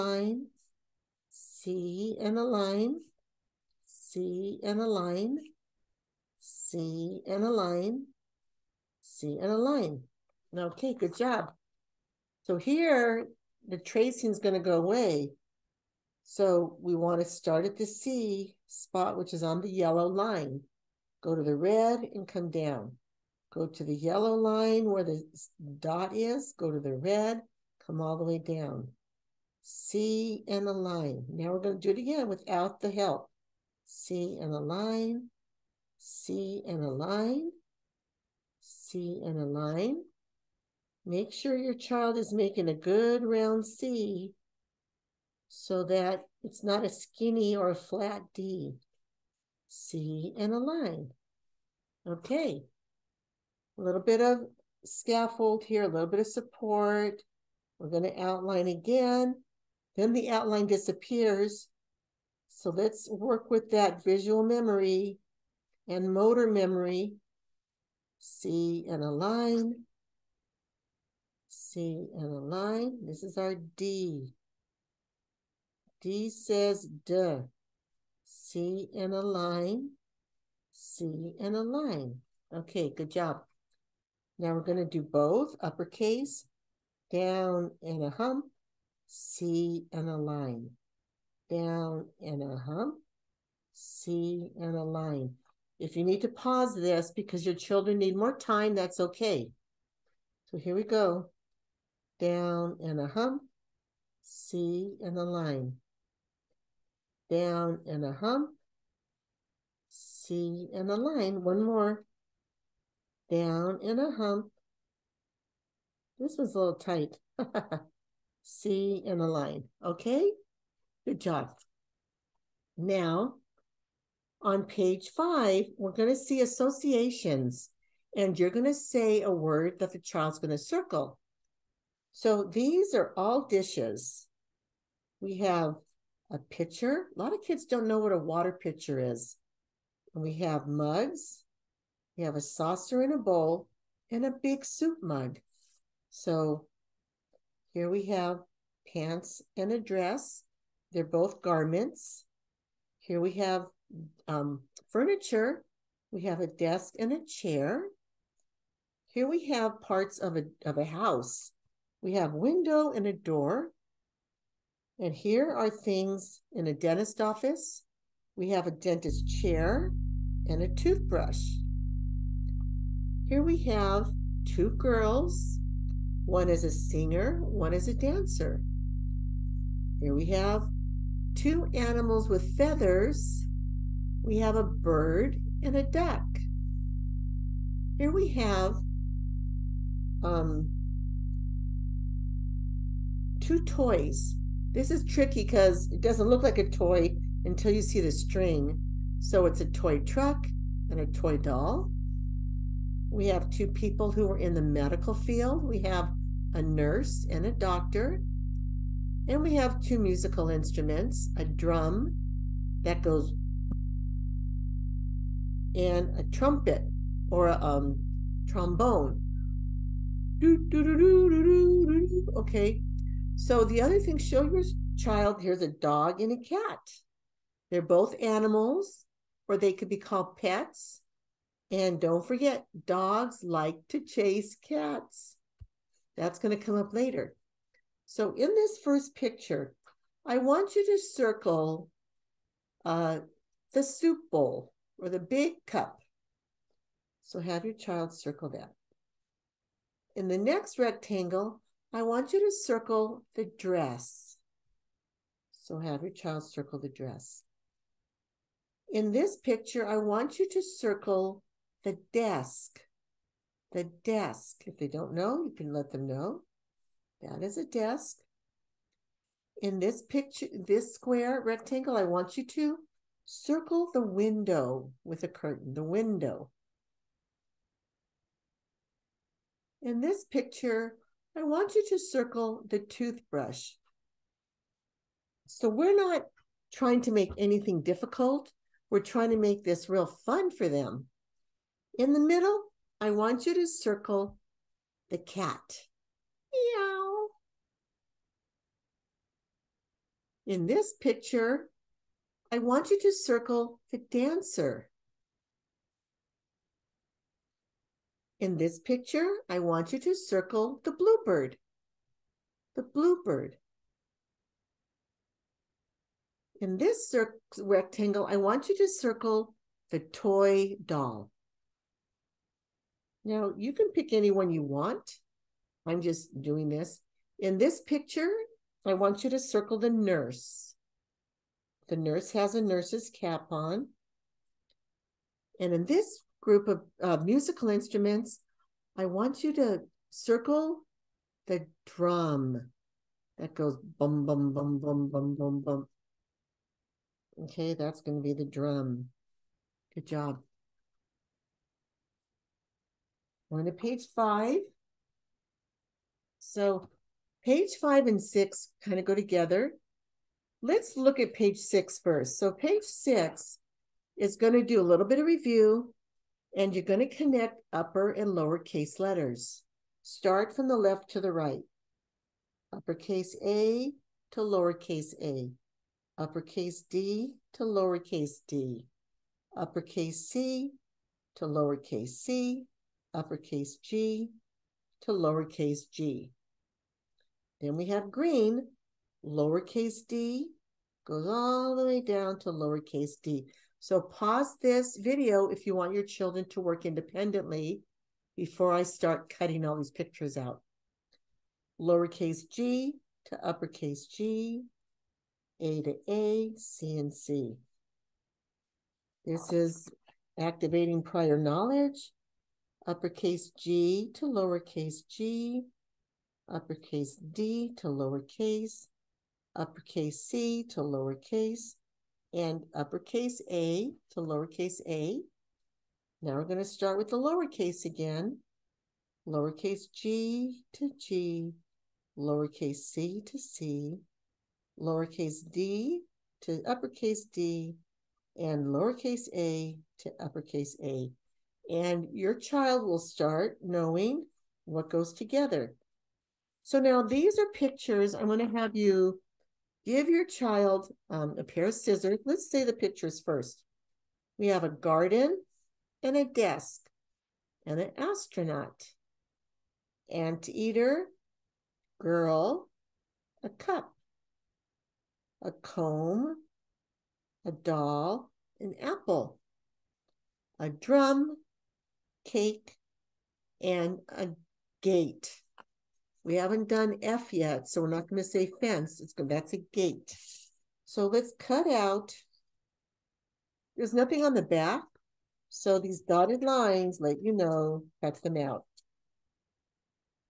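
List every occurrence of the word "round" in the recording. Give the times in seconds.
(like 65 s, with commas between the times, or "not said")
43 s.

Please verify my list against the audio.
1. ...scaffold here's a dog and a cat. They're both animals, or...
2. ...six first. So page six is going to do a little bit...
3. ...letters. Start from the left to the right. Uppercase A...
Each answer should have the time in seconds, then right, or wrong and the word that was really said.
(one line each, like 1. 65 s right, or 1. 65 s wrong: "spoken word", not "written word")
1. 224 s wrong: "child", not "scaffold"
2. 361 s right
3. 368 s right.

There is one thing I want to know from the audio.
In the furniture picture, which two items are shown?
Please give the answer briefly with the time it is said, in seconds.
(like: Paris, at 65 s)
a desk and a chair, at 156 s.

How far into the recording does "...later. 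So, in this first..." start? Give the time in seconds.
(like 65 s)
236 s.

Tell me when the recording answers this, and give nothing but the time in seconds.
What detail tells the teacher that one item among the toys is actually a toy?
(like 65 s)
198 s.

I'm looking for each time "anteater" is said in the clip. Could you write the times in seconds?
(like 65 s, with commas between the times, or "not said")
460 s.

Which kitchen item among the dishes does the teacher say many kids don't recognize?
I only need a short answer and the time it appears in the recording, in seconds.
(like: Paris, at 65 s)
water pitcher, at 138 s.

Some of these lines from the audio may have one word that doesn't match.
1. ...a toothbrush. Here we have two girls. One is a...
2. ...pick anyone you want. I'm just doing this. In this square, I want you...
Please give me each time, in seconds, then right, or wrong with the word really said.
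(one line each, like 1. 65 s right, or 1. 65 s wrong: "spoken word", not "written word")
1. 170 s right
2. 323 s wrong: "picture", not "square".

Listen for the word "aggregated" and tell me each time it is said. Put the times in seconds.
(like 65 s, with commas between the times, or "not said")
not said.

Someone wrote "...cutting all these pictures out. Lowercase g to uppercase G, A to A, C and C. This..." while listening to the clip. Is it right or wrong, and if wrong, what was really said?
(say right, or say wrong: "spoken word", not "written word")
right.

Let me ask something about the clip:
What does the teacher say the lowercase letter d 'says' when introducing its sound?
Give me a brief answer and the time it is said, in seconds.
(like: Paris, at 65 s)
duh, at 76 s.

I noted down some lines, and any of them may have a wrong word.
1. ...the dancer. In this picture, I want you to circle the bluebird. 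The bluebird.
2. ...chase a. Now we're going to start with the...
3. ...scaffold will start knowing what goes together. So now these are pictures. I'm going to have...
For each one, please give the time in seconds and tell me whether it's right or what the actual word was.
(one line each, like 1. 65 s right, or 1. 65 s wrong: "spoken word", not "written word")
1. 303 s right
2. 424 s wrong: "lowercase", not "chase"
3. 442 s wrong: "child", not "scaffold".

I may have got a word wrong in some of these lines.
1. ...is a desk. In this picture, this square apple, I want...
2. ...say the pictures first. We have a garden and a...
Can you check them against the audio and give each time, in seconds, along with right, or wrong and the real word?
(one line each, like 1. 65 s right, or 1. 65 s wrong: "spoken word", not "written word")
1. 267 s wrong: "rectangle", not "apple"
2. 452 s right.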